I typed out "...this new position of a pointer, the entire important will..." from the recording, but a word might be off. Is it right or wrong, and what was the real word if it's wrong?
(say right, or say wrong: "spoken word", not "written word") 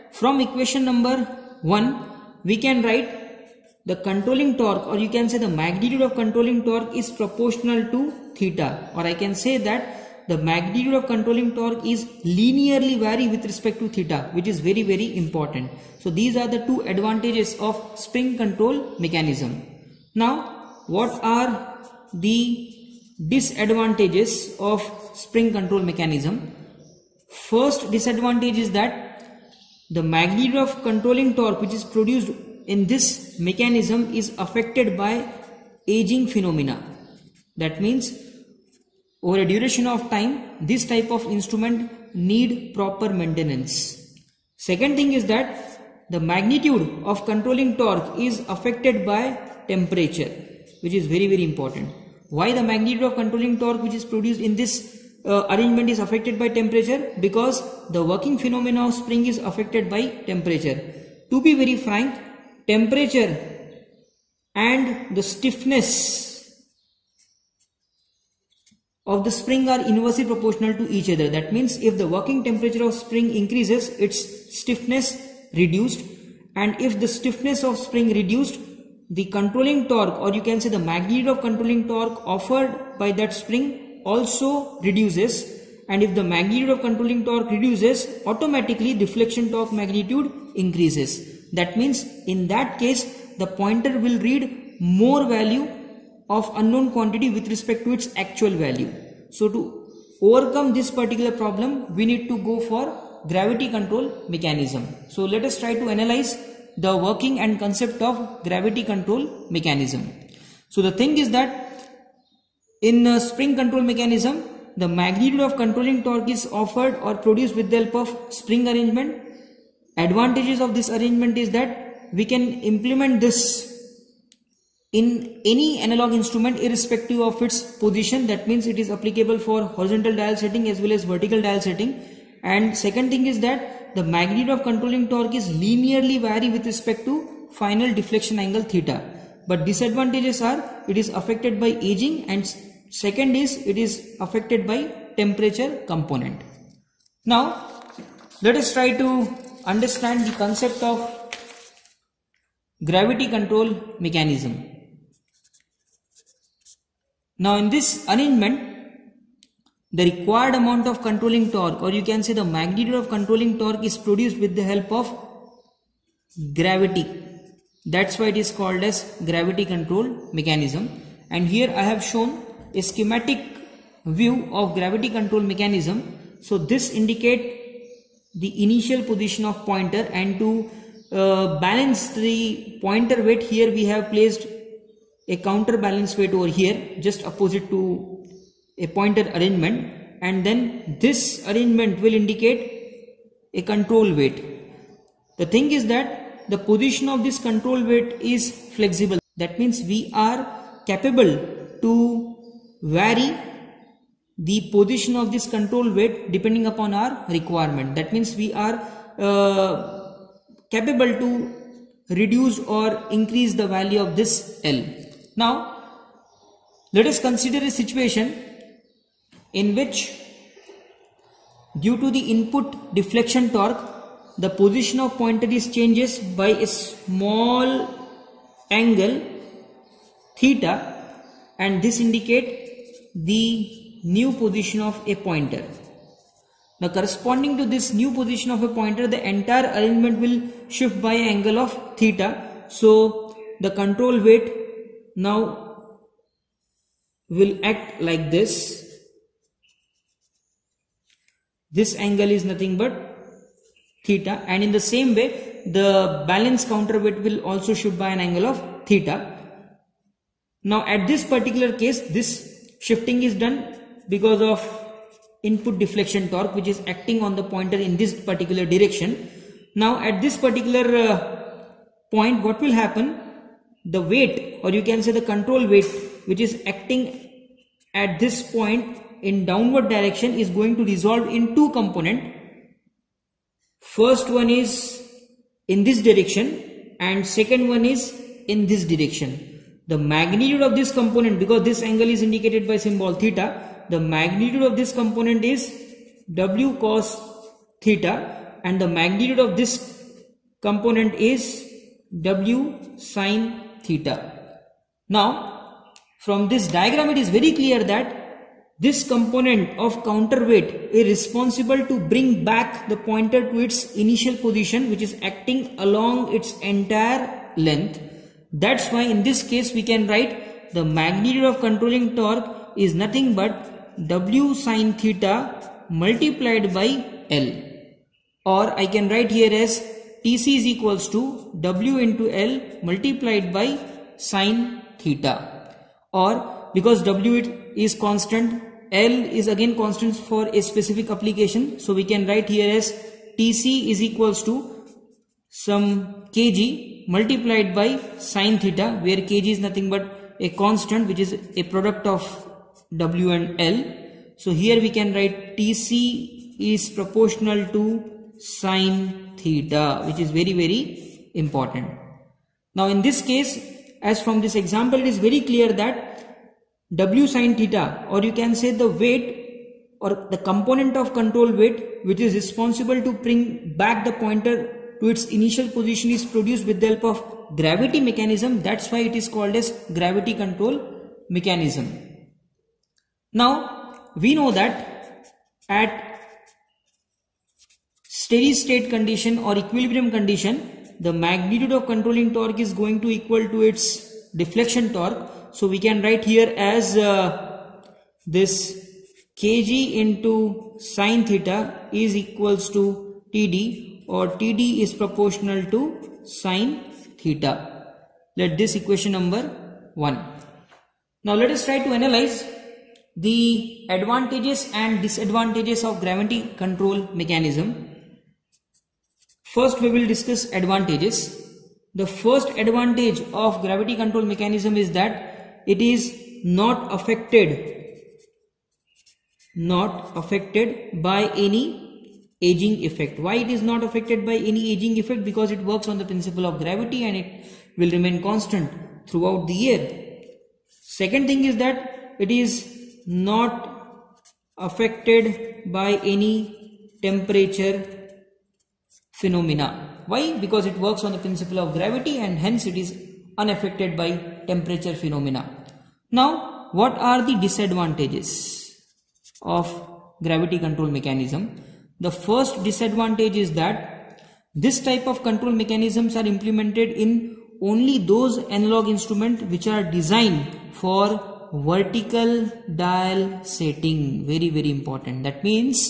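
wrong: "arrangement", not "important".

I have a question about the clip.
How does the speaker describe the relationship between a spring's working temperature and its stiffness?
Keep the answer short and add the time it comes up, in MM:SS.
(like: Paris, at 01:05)
Inversely proportional, at 01:09.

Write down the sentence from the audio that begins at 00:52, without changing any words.
Why the magnitude of controlling torque which is produced in this uh, arrangement is affected by temperature?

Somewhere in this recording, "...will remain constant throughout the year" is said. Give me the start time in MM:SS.
07:17.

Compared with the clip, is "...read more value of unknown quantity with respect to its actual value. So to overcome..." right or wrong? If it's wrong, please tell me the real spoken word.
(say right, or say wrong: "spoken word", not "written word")
right.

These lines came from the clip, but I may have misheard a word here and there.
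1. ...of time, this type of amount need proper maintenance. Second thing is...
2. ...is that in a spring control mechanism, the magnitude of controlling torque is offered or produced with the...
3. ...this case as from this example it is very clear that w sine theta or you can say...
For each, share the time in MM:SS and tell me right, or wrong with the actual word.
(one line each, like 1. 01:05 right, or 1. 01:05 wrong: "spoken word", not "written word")
1. 00:39 wrong: "instrument", not "amount"
2. 01:51 right
3. 06:03 right.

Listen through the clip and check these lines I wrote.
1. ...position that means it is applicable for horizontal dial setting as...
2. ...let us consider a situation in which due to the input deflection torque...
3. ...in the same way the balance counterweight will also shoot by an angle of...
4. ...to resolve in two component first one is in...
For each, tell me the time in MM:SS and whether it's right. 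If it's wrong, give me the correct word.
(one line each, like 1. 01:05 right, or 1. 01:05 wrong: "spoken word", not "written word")
1. 02:07 right
2. 03:36 right
3. 04:14 right
4. 04:40 right.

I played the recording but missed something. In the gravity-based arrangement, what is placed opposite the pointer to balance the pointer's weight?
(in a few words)
Counterbalance weight.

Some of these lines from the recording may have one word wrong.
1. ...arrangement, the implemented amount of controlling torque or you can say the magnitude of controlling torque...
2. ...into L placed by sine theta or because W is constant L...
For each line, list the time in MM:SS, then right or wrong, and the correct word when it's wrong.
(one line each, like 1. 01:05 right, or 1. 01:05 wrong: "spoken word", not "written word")
1. 02:38 wrong: "required", not "implemented"
2. 05:31 wrong: "multiplied", not "placed".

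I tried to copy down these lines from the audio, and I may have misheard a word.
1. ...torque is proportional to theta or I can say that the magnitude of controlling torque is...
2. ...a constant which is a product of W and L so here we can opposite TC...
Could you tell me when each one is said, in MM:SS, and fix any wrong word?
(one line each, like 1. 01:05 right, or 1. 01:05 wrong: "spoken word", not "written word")
1. 00:06 right
2. 05:50 wrong: "write", not "opposite".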